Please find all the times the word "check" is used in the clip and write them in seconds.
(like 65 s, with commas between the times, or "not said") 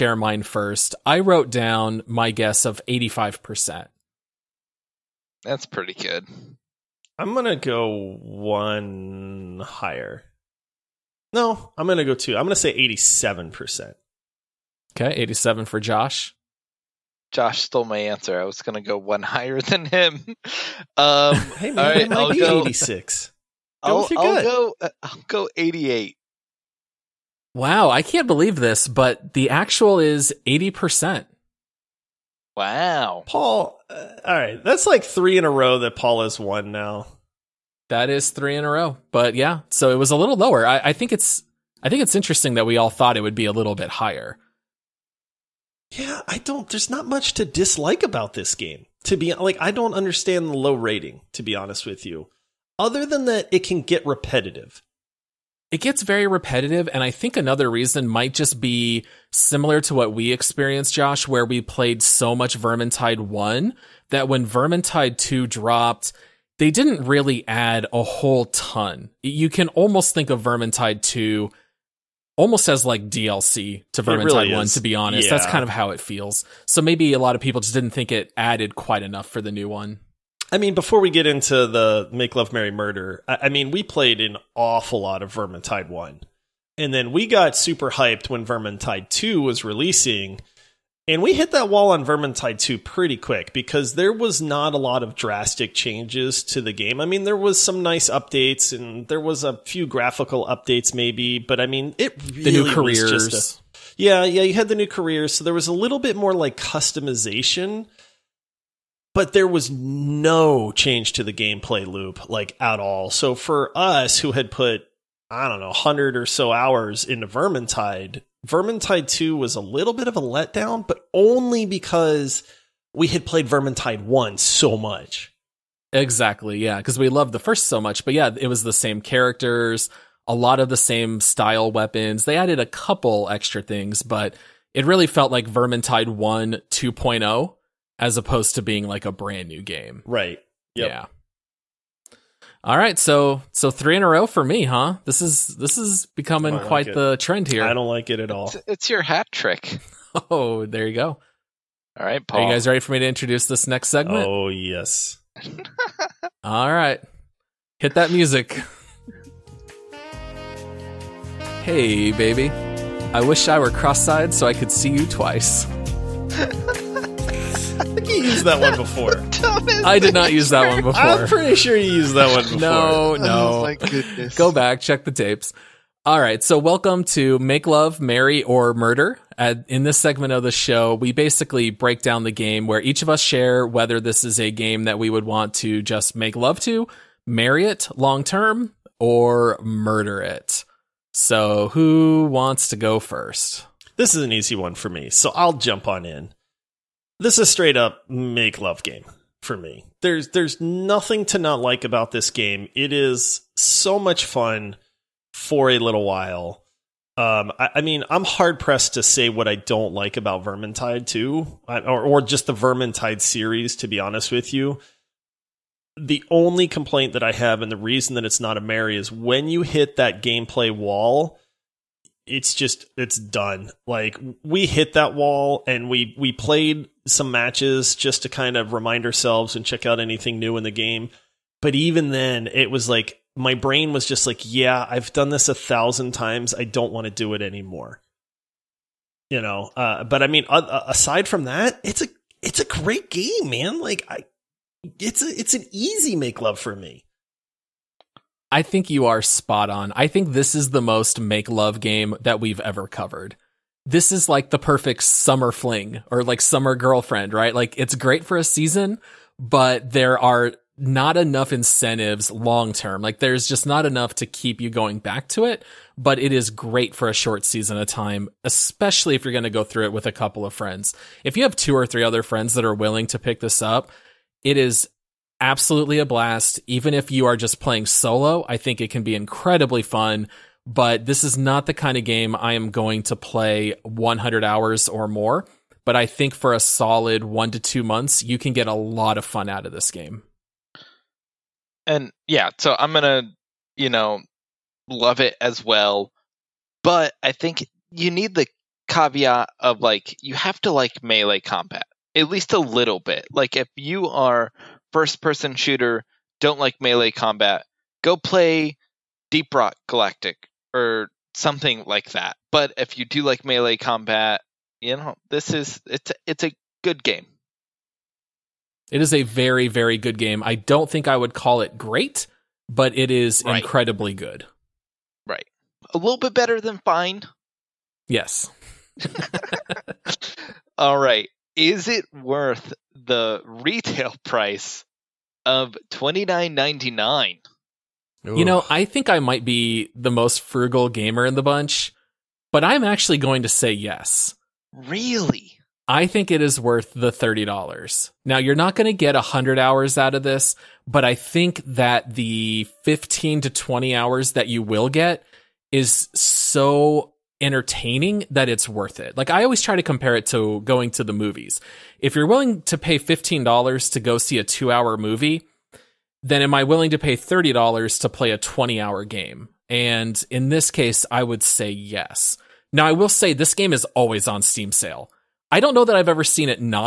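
174 s, 229 s.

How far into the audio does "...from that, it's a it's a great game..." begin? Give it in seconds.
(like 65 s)
241 s.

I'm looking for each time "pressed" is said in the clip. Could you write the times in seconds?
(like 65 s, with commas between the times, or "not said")
208 s.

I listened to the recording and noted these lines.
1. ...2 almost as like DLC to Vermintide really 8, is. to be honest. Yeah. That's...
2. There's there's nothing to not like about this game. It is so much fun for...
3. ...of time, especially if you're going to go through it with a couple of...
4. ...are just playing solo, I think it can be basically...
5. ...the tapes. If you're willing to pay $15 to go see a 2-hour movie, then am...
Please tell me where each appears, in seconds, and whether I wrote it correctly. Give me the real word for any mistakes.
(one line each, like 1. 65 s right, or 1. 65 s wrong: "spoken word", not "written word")
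1. 71 s wrong: "1", not "8"
2. 200 s right
3. 267 s right
4. 277 s wrong: "incredibly", not "basically"
5. 361 s wrong: "movies", not "tapes".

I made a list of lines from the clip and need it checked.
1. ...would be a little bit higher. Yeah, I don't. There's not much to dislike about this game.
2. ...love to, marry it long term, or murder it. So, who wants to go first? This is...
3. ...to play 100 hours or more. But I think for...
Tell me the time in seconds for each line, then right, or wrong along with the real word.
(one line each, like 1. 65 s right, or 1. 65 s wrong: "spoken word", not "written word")
1. 43 s right
2. 186 s right
3. 283 s right.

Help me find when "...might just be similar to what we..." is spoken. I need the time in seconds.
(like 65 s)
58 s.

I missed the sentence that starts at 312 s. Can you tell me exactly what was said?
But if you do like melee combat, you know, this is it's it's a good game.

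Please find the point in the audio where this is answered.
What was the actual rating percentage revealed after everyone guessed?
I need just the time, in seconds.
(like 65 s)
30 s.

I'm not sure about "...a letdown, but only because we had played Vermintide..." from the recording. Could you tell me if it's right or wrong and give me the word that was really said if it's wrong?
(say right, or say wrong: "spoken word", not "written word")
right.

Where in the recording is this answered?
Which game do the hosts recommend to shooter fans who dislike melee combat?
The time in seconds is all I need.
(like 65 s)
309 s.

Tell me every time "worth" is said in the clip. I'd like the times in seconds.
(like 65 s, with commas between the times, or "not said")
332 s, 346 s, 358 s.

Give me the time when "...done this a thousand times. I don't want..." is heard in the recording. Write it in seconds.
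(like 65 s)
235 s.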